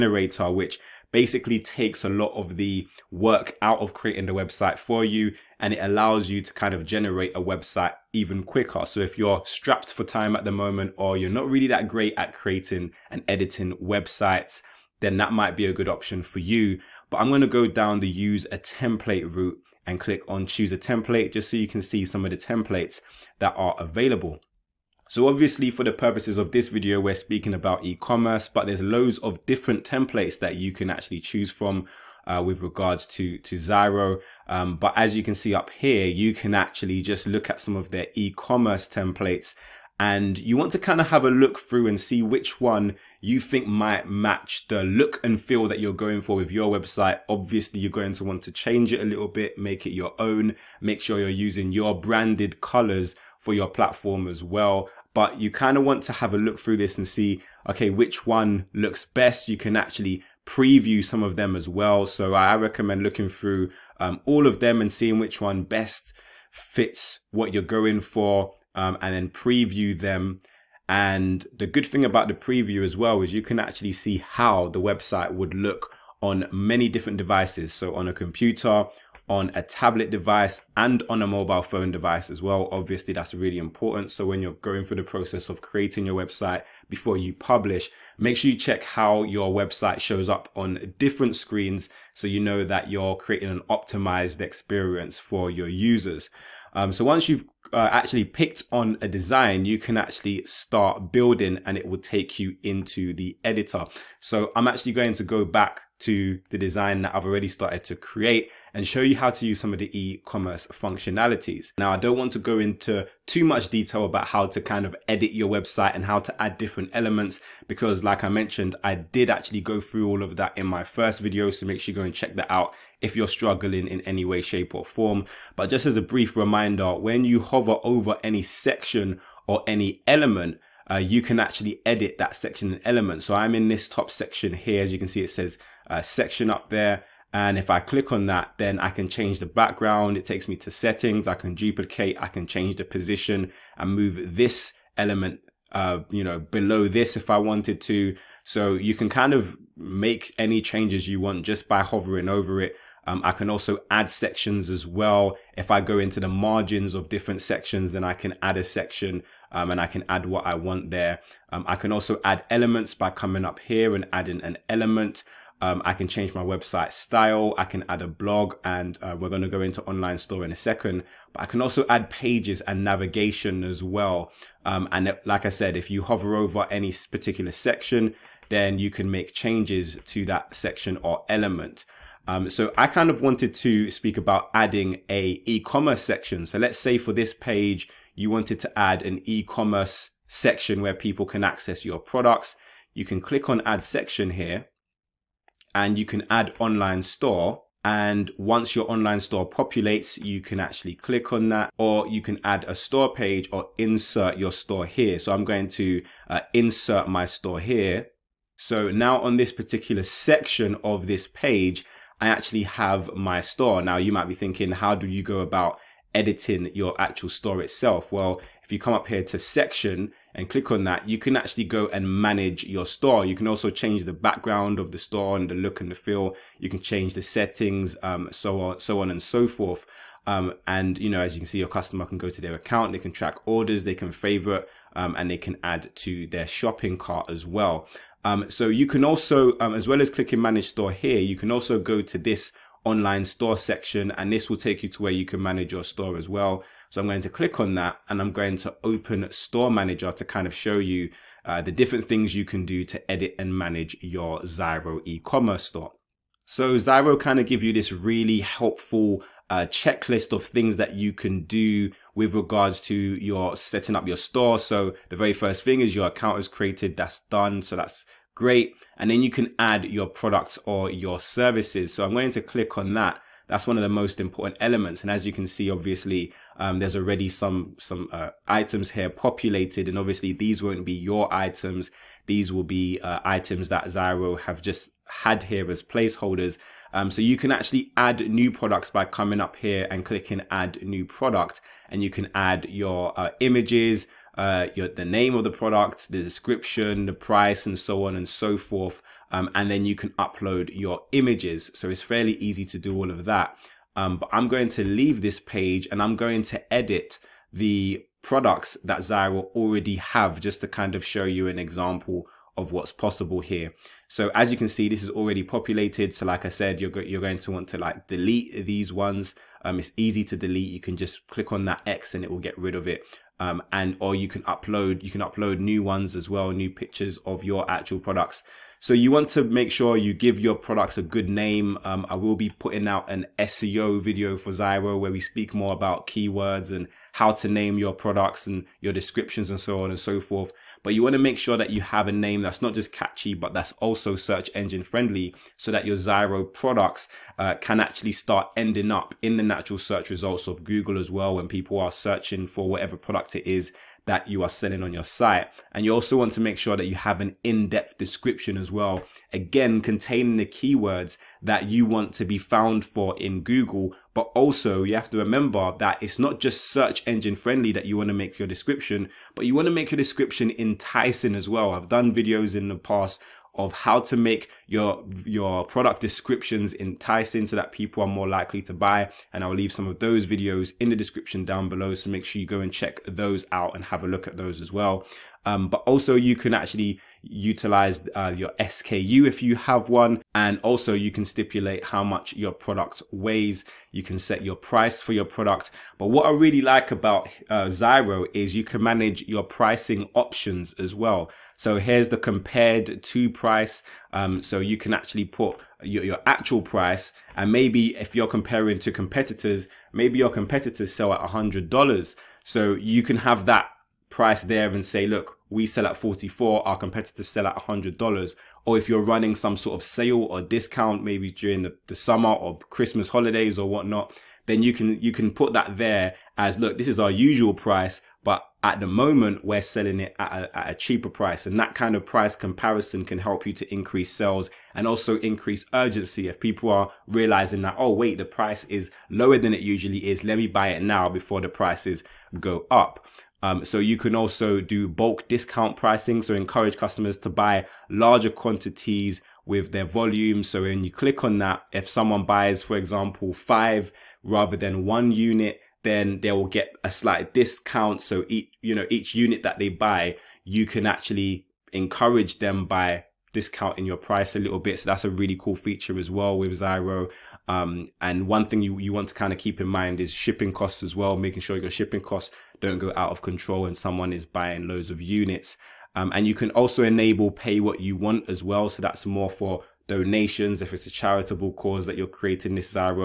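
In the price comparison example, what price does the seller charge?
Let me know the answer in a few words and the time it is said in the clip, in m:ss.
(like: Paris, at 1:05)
44, at 6:55.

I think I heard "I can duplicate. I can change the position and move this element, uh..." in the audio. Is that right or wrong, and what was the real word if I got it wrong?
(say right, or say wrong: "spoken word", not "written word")
right.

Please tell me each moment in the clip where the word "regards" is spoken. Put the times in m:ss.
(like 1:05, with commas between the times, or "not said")
0:32, 4:22.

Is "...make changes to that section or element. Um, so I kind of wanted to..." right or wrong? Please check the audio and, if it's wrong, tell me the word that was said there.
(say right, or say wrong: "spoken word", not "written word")
right.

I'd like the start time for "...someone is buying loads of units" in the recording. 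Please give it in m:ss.
7:53.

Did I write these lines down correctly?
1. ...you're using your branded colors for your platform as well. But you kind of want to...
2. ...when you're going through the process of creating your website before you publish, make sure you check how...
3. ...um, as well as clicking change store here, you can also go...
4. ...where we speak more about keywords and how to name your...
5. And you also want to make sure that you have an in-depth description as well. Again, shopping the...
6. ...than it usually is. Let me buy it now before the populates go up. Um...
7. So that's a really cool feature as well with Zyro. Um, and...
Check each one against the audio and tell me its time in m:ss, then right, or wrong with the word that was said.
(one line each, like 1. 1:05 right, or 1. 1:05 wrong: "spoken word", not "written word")
1. 0:51 right
2. 1:24 right
3. 3:59 wrong: "manage", not "change"
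4. 5:34 right
5. 5:55 wrong: "containing", not "shopping"
6. 7:19 wrong: "prices", not "populates"
7. 7:44 right.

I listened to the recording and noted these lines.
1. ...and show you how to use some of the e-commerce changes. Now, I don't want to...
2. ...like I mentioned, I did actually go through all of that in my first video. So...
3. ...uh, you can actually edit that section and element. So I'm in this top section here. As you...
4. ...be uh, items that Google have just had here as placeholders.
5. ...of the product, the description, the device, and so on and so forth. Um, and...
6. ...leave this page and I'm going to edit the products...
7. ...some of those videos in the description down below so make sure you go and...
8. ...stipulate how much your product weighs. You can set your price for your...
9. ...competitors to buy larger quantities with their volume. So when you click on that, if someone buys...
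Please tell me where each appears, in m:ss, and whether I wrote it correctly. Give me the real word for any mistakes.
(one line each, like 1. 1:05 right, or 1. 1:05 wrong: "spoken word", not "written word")
1. 1:48 wrong: "functionalities", not "changes"
2. 1:58 right
3. 2:10 right
4. 4:42 wrong: "Zyro", not "Google"
5. 4:55 wrong: "price", not "device"
6. 5:04 right
7. 6:19 right
8. 6:31 right
9. 7:26 wrong: "customers", not "competitors".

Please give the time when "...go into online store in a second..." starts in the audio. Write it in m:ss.
2:49.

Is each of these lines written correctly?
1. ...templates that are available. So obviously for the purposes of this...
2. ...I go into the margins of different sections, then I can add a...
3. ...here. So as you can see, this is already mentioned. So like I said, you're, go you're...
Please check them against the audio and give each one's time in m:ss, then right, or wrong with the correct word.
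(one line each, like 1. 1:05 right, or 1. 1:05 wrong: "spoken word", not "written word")
1. 0:22 right
2. 2:35 right
3. 5:13 wrong: "populated", not "mentioned".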